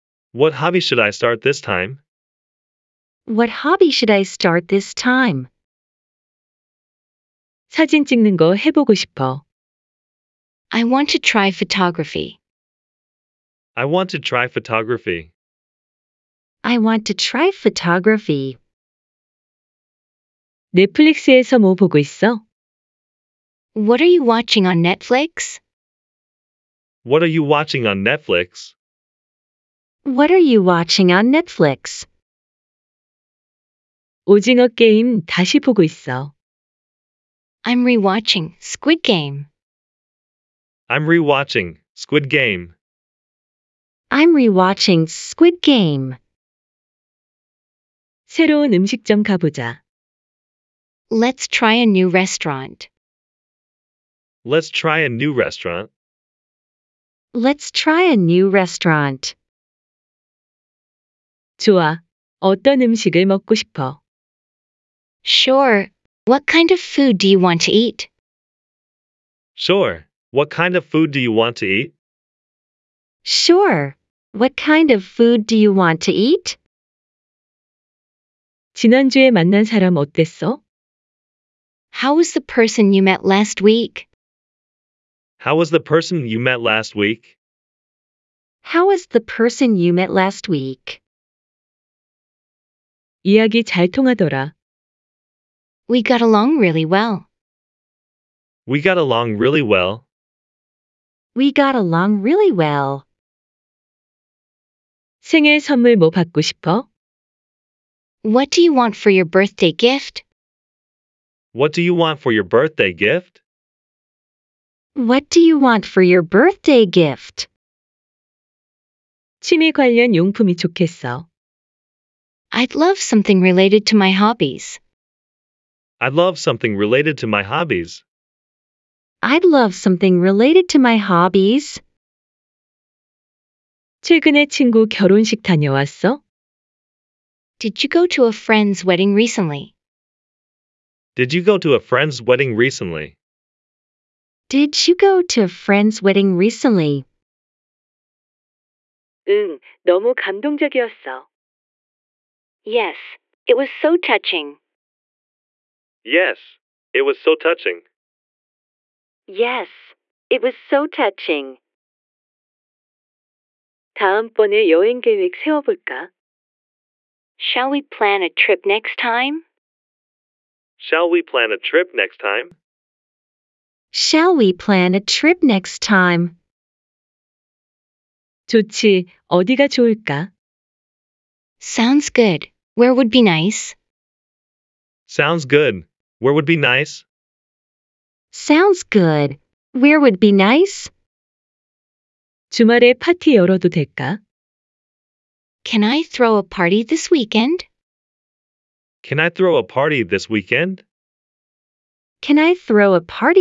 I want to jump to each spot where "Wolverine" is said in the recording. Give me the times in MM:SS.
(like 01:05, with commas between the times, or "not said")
not said.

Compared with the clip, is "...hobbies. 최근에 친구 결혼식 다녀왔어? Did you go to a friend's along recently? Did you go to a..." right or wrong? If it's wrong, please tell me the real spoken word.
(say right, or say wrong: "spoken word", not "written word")
wrong: "wedding", not "along".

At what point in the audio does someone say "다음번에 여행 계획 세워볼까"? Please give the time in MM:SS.
02:43.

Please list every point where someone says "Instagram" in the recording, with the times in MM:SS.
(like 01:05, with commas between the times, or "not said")
not said.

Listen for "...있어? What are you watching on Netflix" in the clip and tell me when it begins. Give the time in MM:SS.
00:21.